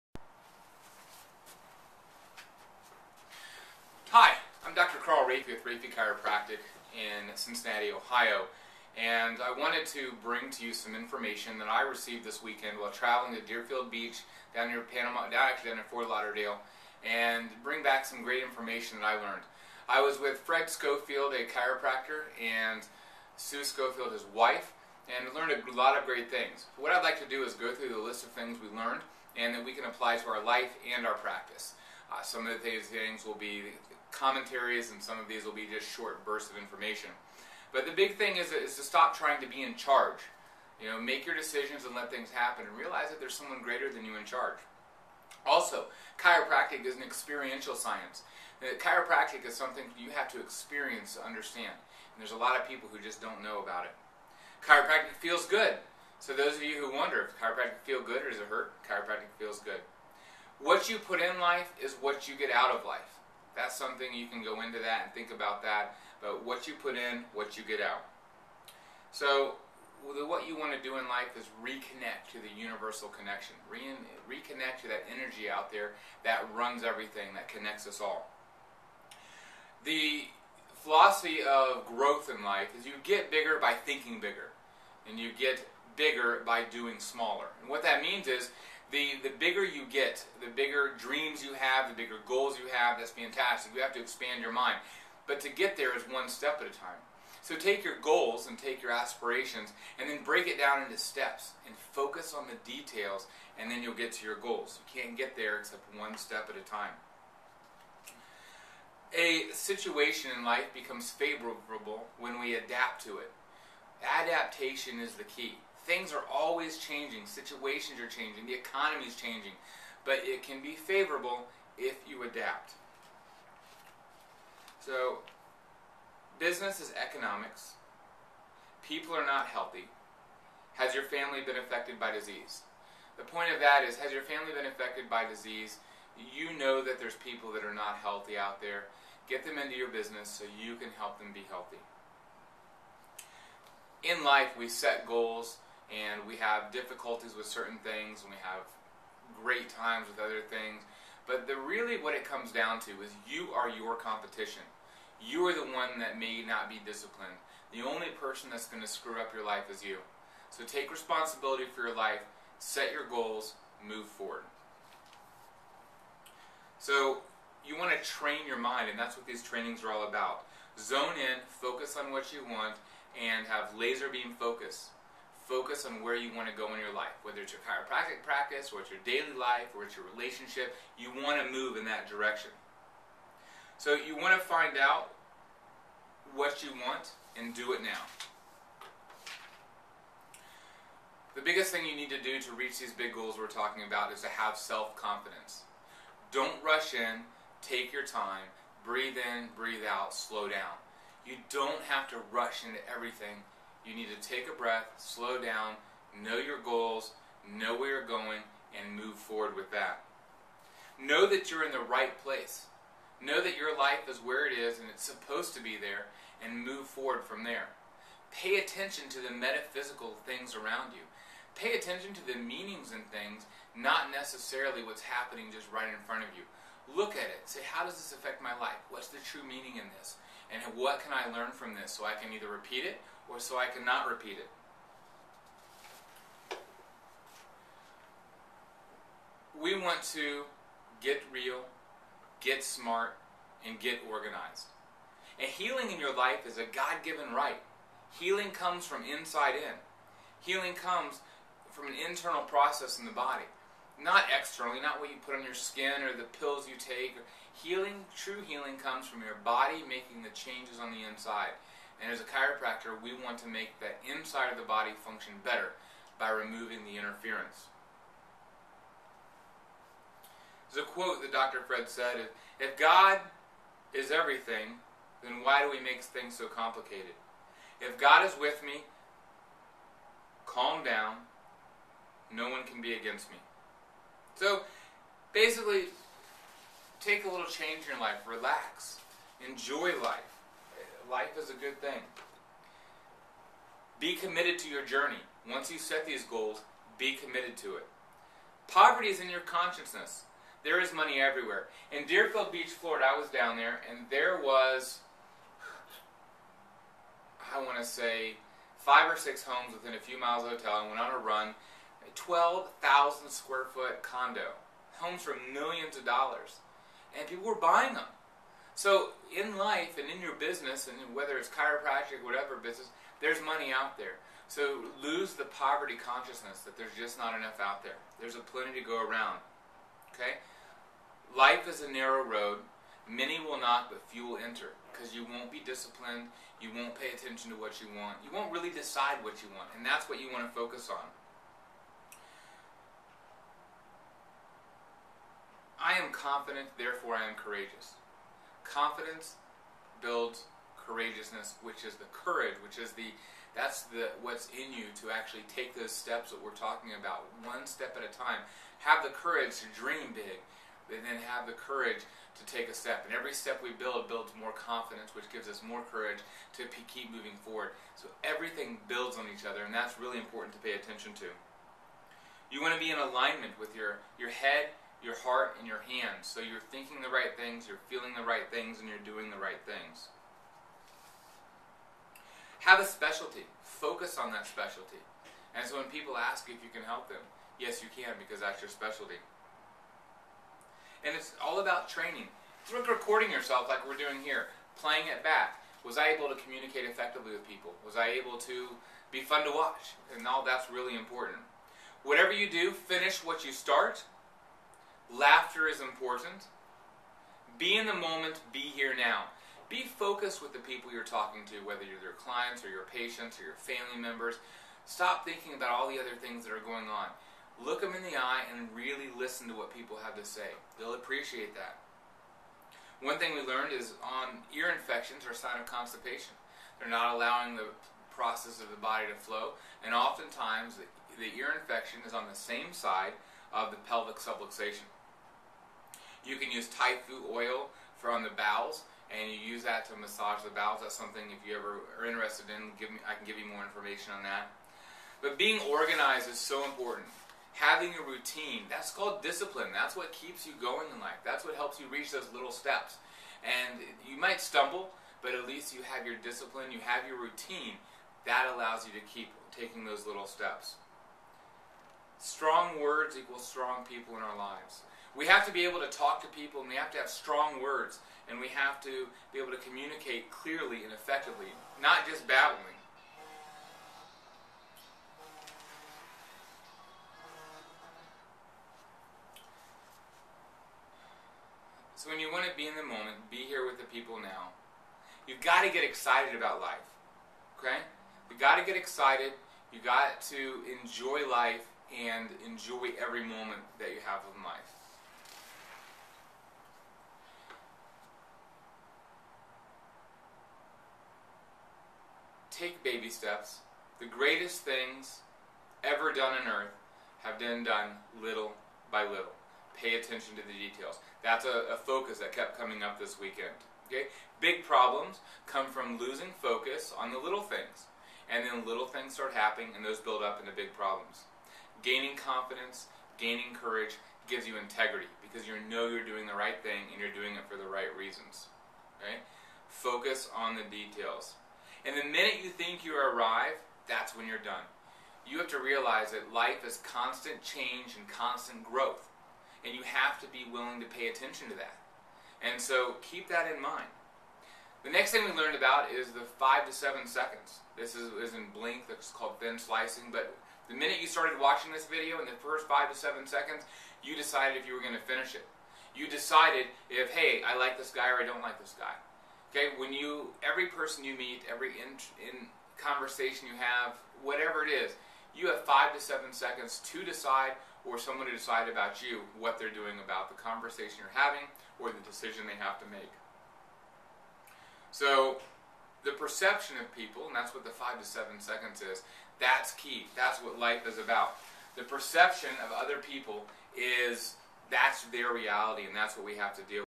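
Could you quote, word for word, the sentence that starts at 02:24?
In life, we set goals and we have difficulties with certain things and we have great times with other things.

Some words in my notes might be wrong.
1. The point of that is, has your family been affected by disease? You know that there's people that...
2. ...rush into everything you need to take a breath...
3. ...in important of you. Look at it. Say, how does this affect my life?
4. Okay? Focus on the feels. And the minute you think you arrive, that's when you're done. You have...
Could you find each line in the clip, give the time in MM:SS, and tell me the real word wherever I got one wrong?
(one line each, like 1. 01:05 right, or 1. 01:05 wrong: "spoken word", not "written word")
1. 02:13 right
2. 03:22 right
3. 03:45 wrong: "front", not "important"
4. 08:48 wrong: "details", not "feels".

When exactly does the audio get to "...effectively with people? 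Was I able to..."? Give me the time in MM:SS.
06:36.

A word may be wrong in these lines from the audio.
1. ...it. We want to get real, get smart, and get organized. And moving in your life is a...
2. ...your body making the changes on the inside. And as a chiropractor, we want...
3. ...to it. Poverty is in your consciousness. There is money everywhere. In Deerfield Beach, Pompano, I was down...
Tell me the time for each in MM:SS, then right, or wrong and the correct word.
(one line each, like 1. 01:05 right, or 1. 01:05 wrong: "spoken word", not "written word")
1. 03:54 wrong: "healing", not "moving"
2. 04:19 right
3. 04:57 wrong: "Florida", not "Pompano".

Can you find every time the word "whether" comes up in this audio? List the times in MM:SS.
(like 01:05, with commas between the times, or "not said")
02:57, 05:21, 06:51.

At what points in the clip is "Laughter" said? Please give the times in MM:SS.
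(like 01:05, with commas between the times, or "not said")
06:45.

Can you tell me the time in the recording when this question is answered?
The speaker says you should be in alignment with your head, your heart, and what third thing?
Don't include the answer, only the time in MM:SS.
06:15.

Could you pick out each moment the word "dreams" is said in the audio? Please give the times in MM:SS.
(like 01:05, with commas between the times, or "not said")
01:30, 05:59.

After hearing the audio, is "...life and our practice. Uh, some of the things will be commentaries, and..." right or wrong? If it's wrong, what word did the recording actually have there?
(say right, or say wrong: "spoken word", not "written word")
right.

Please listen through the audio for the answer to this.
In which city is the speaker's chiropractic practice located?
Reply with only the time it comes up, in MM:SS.
00:07.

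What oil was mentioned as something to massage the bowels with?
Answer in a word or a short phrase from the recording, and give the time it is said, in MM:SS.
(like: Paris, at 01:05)
Taifu oil, at 07:16.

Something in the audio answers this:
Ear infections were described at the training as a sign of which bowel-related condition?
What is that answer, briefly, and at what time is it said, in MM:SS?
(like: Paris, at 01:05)
constipation, at 07:05.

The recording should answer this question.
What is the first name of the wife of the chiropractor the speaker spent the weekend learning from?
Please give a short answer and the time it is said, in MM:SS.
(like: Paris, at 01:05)
Sue, at 00:23.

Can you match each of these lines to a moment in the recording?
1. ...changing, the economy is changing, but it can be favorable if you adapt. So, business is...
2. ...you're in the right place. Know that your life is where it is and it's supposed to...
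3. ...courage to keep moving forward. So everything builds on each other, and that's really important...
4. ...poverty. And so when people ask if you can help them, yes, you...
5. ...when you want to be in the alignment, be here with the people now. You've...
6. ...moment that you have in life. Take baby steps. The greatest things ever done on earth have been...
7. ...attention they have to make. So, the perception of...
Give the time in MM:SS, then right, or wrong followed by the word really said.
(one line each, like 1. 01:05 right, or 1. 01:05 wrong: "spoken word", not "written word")
1. 01:58 right
2. 03:31 right
3. 06:05 right
4. 06:24 wrong: "specialty", not "poverty"
5. 08:02 wrong: "moment", not "alignment"
6. 08:13 right
7. 09:32 wrong: "decision", not "attention".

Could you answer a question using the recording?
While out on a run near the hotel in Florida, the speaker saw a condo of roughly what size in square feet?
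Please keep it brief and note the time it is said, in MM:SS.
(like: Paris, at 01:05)
12,000 square feet, at 05:12.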